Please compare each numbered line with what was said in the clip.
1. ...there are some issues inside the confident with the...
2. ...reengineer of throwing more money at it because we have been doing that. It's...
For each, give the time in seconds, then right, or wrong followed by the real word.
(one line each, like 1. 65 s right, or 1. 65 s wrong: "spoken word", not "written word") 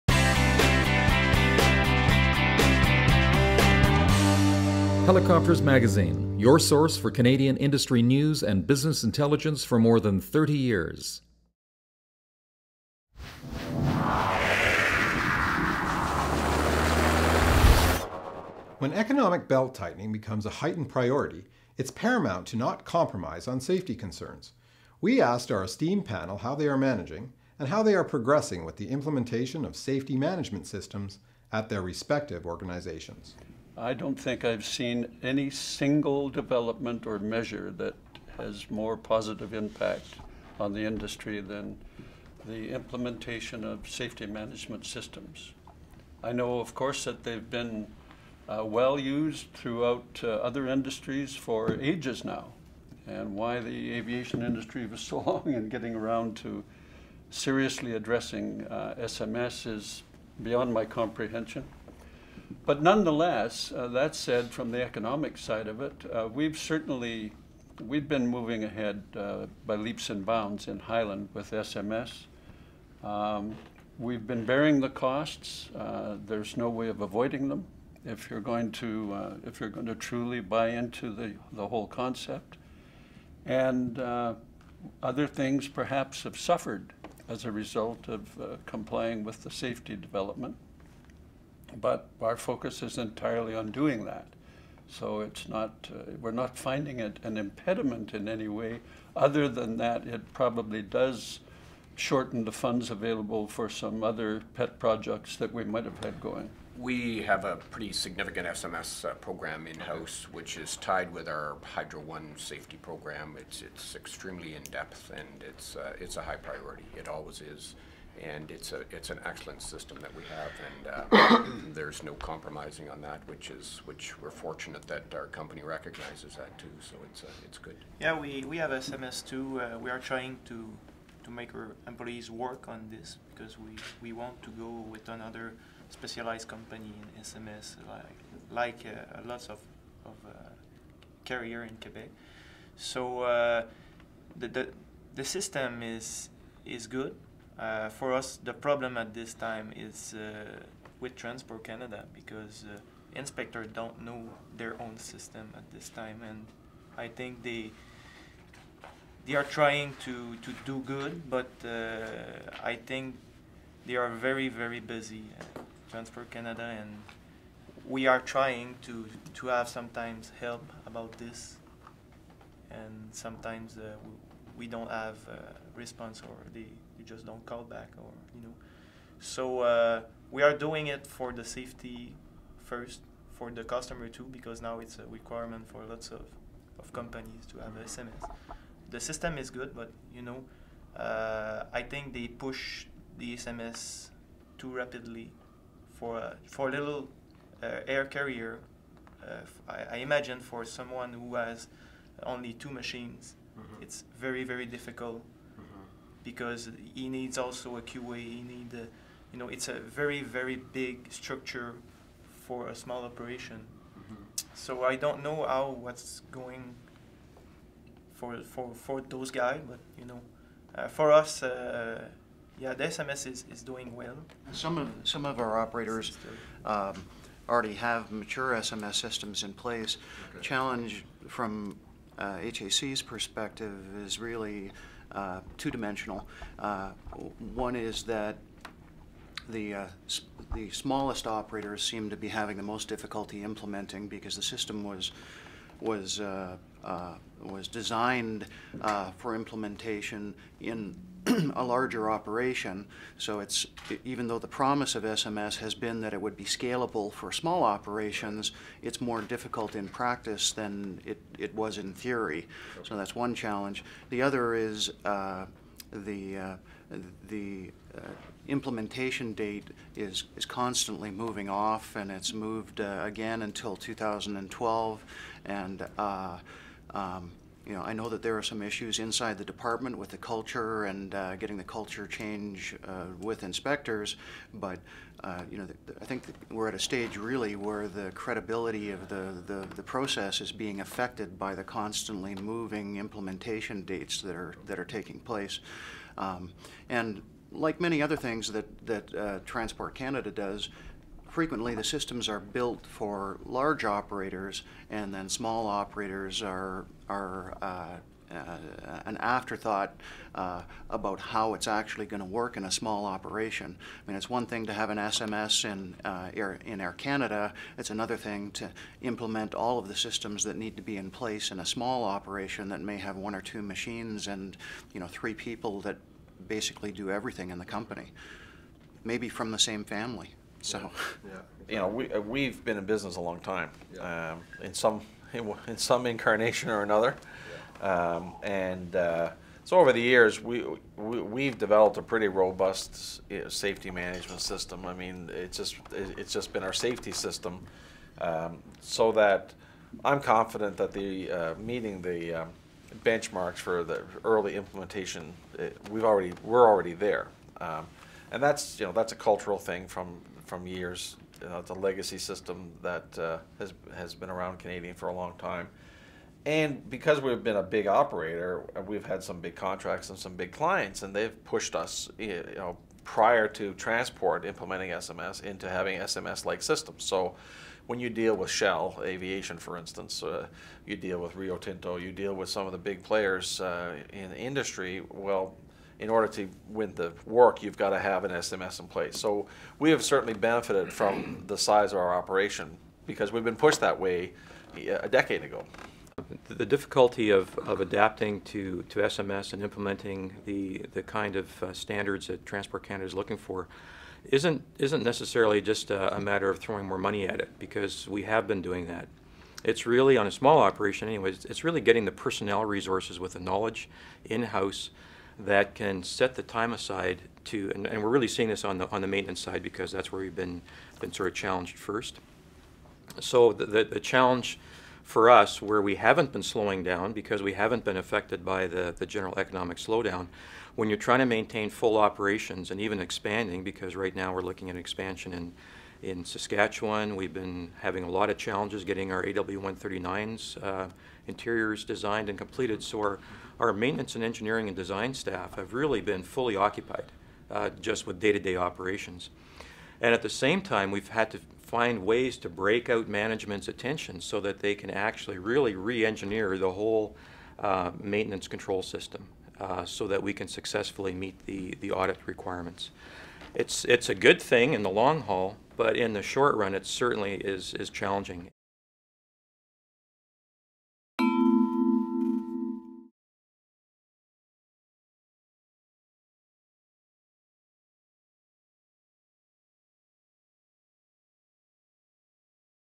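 1. 278 s wrong: "department", not "confident"
2. 406 s wrong: "matter", not "reengineer".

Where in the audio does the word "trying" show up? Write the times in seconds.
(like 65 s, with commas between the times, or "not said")
129 s, 159 s, 168 s, 430 s.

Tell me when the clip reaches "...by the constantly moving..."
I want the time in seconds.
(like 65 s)
291 s.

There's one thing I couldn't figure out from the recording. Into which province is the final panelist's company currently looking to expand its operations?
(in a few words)
Saskatchewan.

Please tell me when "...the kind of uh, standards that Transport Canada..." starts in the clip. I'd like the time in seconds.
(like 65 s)
400 s.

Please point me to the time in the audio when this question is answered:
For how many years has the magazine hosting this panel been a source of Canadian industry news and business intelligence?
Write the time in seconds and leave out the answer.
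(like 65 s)
9 s.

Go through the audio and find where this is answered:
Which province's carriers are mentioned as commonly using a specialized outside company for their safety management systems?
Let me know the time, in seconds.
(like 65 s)
141 s.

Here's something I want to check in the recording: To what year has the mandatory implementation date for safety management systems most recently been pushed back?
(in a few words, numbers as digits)
2012.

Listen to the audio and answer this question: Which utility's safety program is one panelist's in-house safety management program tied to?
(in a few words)
Hydro One.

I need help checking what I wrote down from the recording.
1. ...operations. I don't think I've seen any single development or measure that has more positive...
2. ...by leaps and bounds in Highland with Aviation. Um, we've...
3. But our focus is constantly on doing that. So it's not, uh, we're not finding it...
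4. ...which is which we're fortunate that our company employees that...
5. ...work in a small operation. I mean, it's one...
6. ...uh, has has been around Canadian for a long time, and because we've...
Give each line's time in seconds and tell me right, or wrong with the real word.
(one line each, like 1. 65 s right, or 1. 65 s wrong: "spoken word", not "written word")
1. 32 s wrong: "organizations", not "operations"
2. 69 s wrong: "SMS", not "Aviation"
3. 91 s wrong: "entirely", not "constantly"
4. 123 s wrong: "recognizes", not "employees"
5. 312 s right
6. 363 s right.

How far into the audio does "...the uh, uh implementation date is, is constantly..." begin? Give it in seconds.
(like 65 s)
266 s.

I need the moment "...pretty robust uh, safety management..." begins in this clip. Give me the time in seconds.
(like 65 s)
342 s.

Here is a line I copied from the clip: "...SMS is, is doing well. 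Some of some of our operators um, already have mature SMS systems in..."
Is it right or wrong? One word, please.
right.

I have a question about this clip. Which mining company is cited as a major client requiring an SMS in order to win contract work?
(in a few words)
Rio Tinto.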